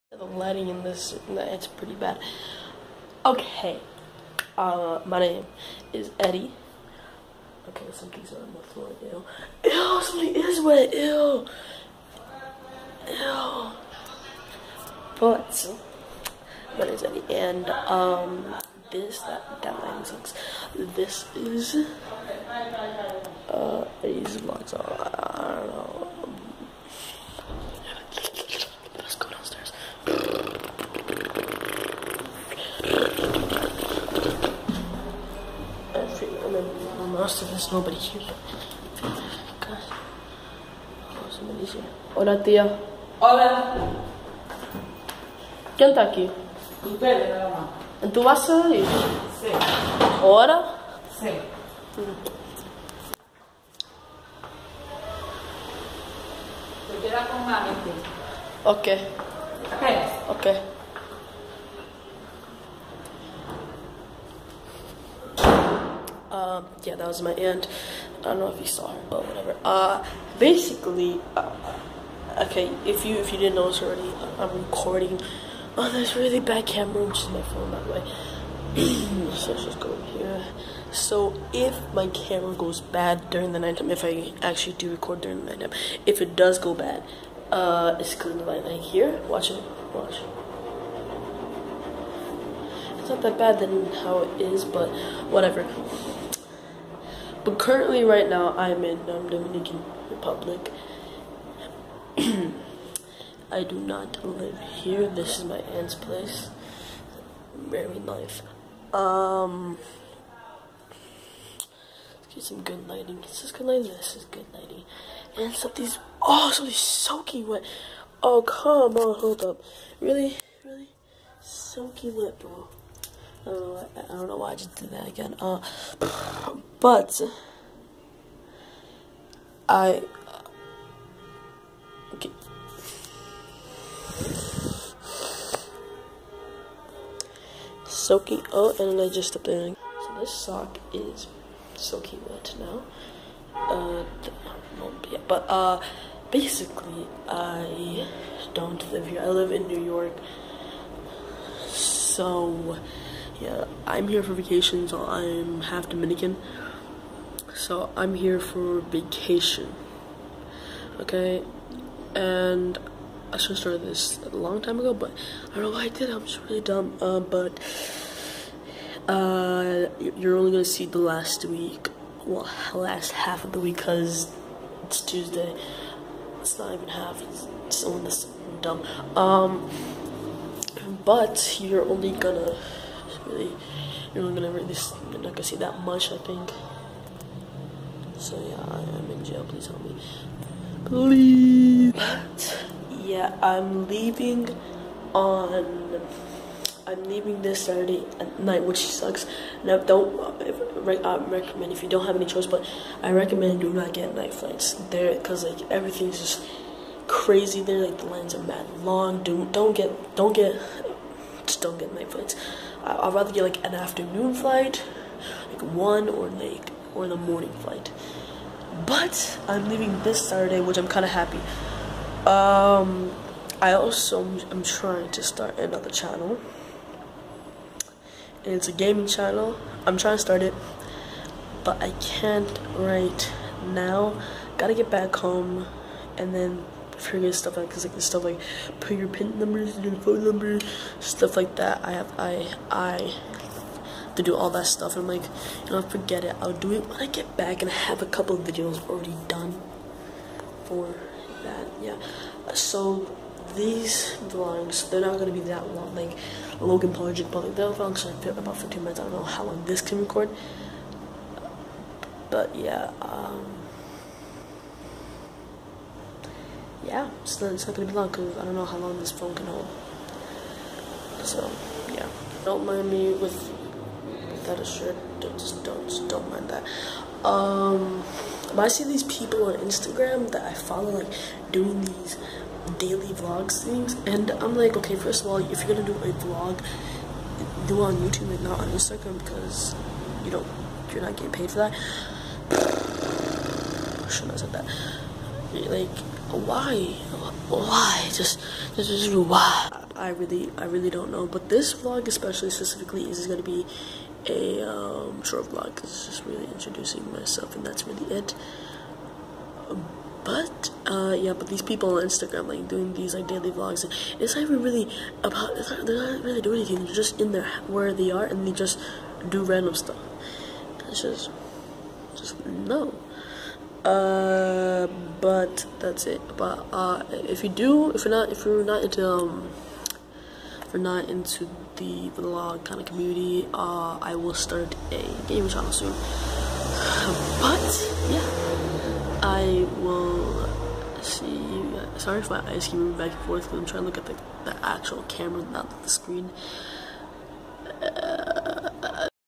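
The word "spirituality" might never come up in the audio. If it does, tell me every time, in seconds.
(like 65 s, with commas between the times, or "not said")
not said.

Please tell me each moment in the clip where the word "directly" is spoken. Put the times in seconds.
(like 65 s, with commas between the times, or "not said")
not said.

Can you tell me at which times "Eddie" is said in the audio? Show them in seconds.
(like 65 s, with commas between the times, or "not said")
6 s, 17 s, 24 s.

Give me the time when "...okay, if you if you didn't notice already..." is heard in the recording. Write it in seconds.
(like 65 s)
72 s.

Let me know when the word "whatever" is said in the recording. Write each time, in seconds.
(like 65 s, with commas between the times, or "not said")
69 s, 95 s.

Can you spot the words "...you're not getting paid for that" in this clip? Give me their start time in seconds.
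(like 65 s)
290 s.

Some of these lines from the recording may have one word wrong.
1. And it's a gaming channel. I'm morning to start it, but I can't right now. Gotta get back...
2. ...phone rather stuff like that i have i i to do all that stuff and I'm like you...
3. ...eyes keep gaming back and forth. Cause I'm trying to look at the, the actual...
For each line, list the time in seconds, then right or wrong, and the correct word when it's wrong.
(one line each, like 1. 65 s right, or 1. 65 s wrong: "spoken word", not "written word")
1. 228 s wrong: "trying", not "morning"
2. 239 s wrong: "number", not "rather"
3. 342 s wrong: "moving", not "gaming".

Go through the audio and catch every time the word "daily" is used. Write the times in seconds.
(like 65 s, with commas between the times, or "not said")
282 s, 313 s.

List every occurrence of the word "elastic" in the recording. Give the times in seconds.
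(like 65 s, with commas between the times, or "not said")
not said.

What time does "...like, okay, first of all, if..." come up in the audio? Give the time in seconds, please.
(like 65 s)
284 s.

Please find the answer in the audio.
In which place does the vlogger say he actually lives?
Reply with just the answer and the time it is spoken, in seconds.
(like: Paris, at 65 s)
New York, at 149 s.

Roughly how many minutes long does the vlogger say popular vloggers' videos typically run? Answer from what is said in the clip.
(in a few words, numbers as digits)
15 minutes.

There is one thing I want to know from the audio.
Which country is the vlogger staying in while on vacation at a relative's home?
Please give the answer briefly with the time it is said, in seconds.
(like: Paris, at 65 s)
Dominican Republic, at 99 s.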